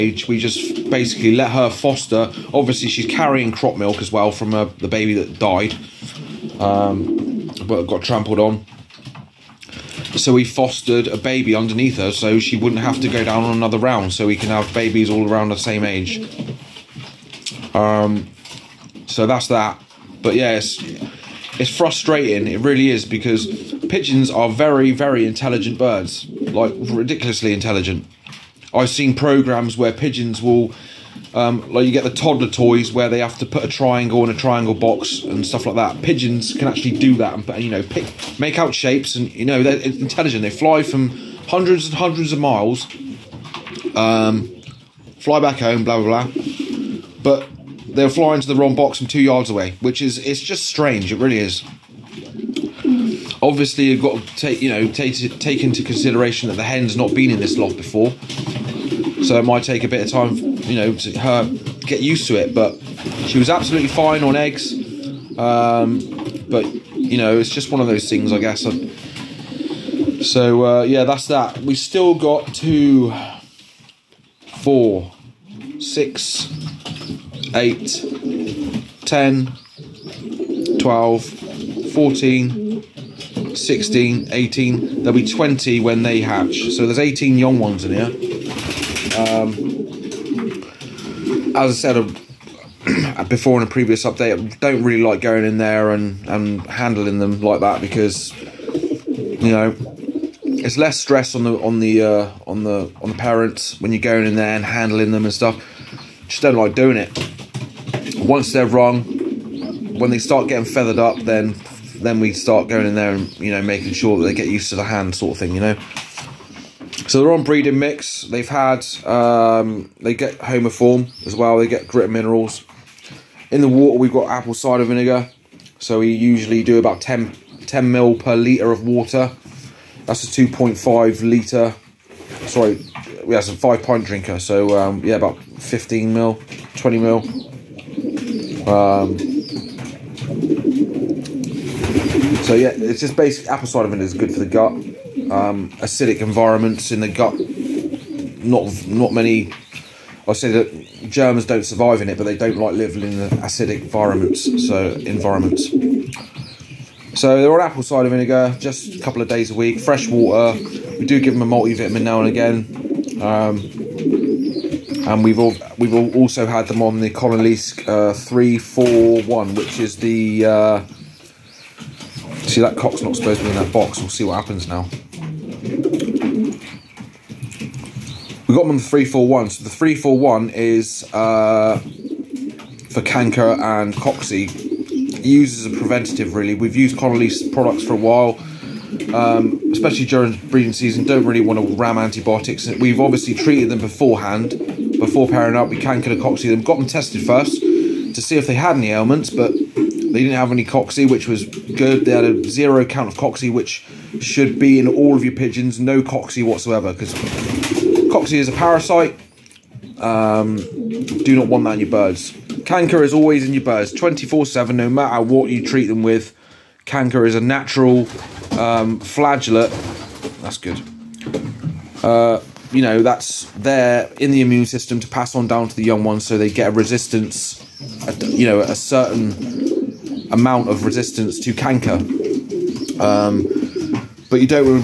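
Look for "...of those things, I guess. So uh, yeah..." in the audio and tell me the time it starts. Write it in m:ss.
1:07.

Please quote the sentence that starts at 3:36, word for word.
Canker is a natural um, flagellate.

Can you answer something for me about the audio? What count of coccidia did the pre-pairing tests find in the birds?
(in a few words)
0.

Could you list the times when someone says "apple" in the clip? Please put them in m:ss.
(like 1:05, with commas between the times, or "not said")
2:04, 2:23, 2:37.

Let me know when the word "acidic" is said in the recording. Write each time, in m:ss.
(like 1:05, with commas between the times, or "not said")
2:25, 2:33.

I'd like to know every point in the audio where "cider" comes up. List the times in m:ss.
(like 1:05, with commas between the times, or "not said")
2:04, 2:23, 2:37.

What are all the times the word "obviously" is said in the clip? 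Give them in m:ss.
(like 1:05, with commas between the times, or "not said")
0:02, 0:53, 3:12.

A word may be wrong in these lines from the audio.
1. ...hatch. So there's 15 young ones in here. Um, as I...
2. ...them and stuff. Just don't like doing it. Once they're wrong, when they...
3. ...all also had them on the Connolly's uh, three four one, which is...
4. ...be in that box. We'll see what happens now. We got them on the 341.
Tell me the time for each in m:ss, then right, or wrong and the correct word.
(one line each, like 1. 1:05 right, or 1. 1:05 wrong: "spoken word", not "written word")
1. 1:26 wrong: "18", not "15"
2. 1:45 right
3. 2:45 right
4. 2:53 right.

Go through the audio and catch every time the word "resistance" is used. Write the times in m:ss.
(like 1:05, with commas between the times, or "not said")
3:46, 3:50.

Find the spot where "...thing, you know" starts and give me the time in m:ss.
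1:55.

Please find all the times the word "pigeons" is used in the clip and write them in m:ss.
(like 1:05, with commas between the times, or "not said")
0:23, 0:29, 0:36, 3:25.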